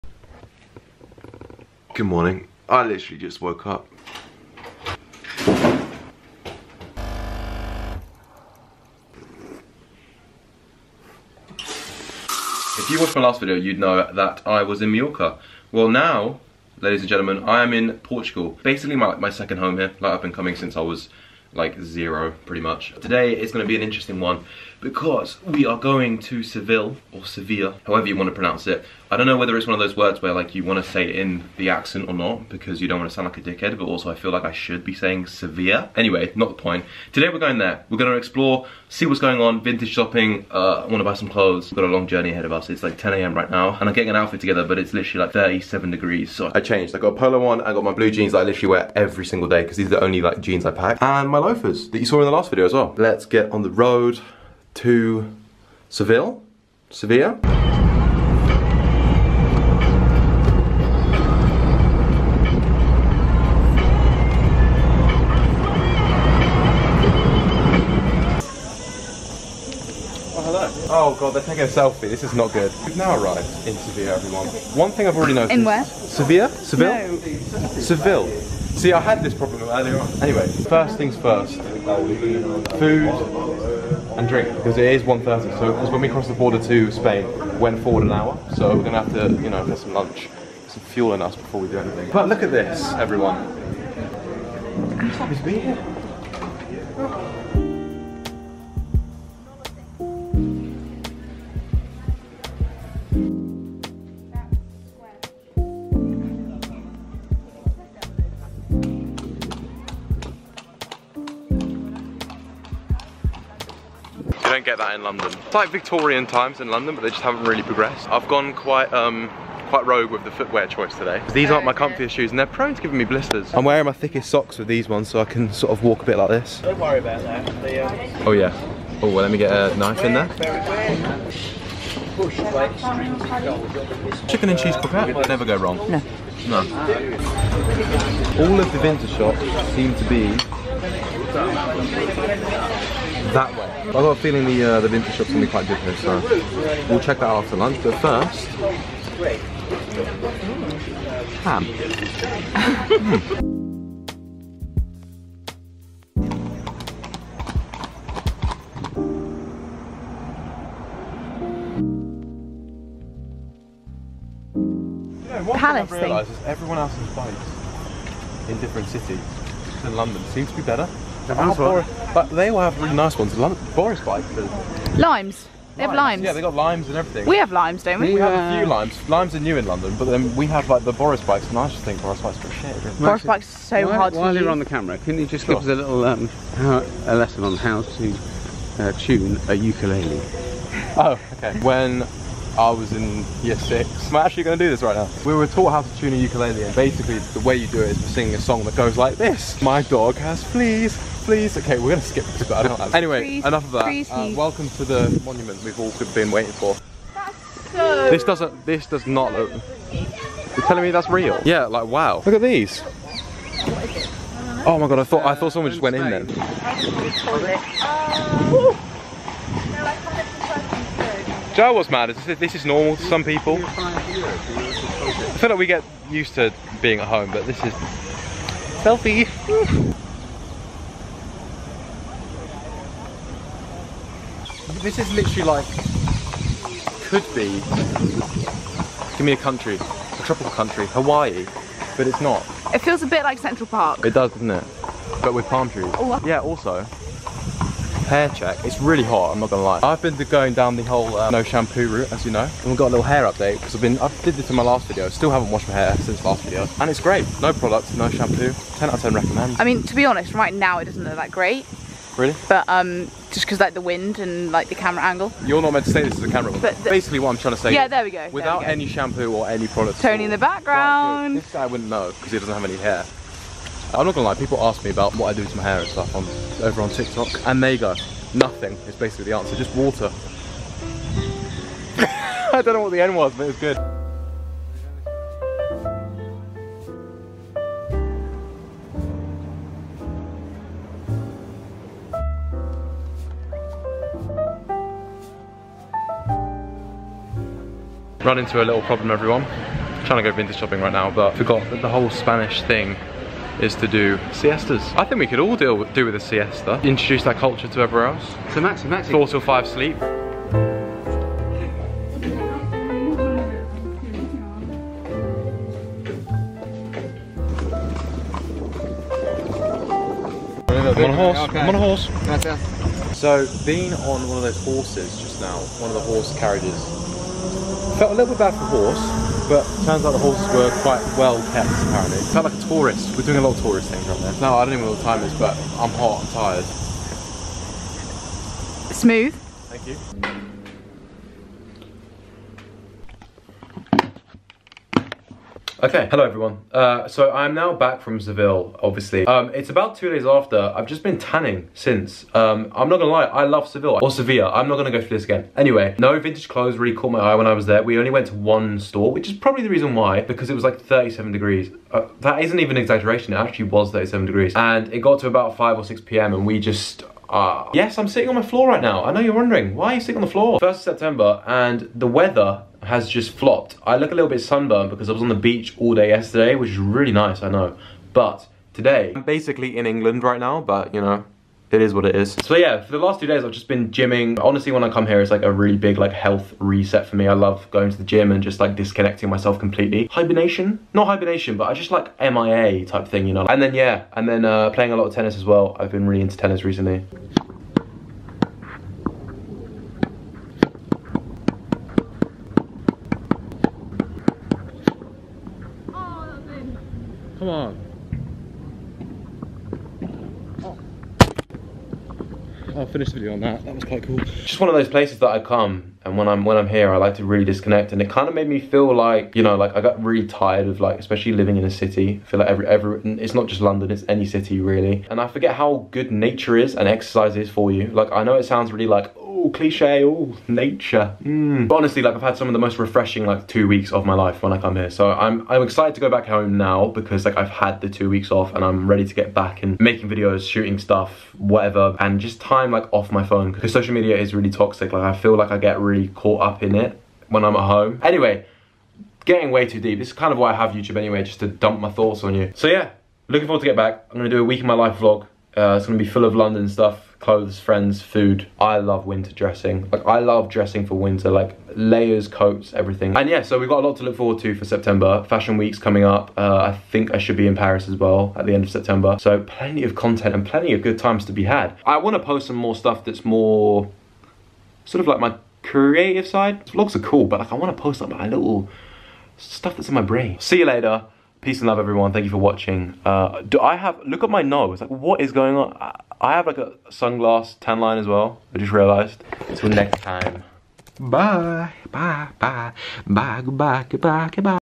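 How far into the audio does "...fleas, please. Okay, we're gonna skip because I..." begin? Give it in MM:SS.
03:20.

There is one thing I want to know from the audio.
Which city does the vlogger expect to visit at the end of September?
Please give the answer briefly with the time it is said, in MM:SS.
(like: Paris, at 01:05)
Paris, at 07:47.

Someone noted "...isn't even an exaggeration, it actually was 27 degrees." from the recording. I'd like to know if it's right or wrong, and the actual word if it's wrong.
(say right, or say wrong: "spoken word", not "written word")
wrong: "37", not "27".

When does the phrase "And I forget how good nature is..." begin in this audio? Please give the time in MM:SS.
07:05.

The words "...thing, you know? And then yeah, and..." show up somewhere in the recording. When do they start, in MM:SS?
06:33.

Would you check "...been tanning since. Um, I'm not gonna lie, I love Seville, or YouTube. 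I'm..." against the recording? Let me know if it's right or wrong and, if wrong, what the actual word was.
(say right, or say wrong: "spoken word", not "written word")
wrong: "Sevilla", not "YouTube".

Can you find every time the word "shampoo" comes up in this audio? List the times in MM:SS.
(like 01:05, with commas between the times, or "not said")
04:11, 04:18, 04:28.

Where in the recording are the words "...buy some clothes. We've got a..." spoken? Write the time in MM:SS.
00:41.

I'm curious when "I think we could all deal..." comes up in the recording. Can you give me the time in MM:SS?
05:04.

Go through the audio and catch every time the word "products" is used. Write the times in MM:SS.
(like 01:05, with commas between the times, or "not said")
04:17, 04:29.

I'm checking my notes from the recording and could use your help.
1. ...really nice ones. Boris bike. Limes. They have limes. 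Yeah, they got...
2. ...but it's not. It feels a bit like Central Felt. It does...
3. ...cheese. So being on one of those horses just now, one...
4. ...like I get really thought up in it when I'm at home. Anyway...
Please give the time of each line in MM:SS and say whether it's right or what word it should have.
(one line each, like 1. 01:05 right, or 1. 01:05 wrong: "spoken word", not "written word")
1. 02:52 right
2. 04:01 wrong: "Park", not "Felt"
3. 05:21 wrong: "horse", not "cheese"
4. 07:25 wrong: "caught", not "thought".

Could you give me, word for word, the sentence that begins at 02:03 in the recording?
I'm wearing my thickest socks with these ones so I can sort of walk a bit like this.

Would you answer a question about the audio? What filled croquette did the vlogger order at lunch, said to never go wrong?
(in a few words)
Chicken and cheese.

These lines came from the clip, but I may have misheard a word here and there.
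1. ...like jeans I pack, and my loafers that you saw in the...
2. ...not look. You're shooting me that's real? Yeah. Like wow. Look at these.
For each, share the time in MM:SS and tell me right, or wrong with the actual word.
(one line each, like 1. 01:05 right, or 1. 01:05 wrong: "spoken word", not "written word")
1. 00:50 right
2. 03:29 wrong: "telling", not "shooting".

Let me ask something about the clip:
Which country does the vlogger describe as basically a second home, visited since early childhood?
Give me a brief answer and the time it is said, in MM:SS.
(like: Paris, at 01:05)
Portugal, at 00:17.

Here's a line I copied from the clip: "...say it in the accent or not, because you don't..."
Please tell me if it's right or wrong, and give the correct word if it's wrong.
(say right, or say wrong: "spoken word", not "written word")
right.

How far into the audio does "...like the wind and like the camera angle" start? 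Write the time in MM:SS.
04:23.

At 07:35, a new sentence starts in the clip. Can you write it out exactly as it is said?
Uh, it's gonna be full of London stuff clothes, friends, food.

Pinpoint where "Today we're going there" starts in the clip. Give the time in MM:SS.
00:37.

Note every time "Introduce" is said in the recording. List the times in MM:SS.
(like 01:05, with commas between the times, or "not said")
05:06.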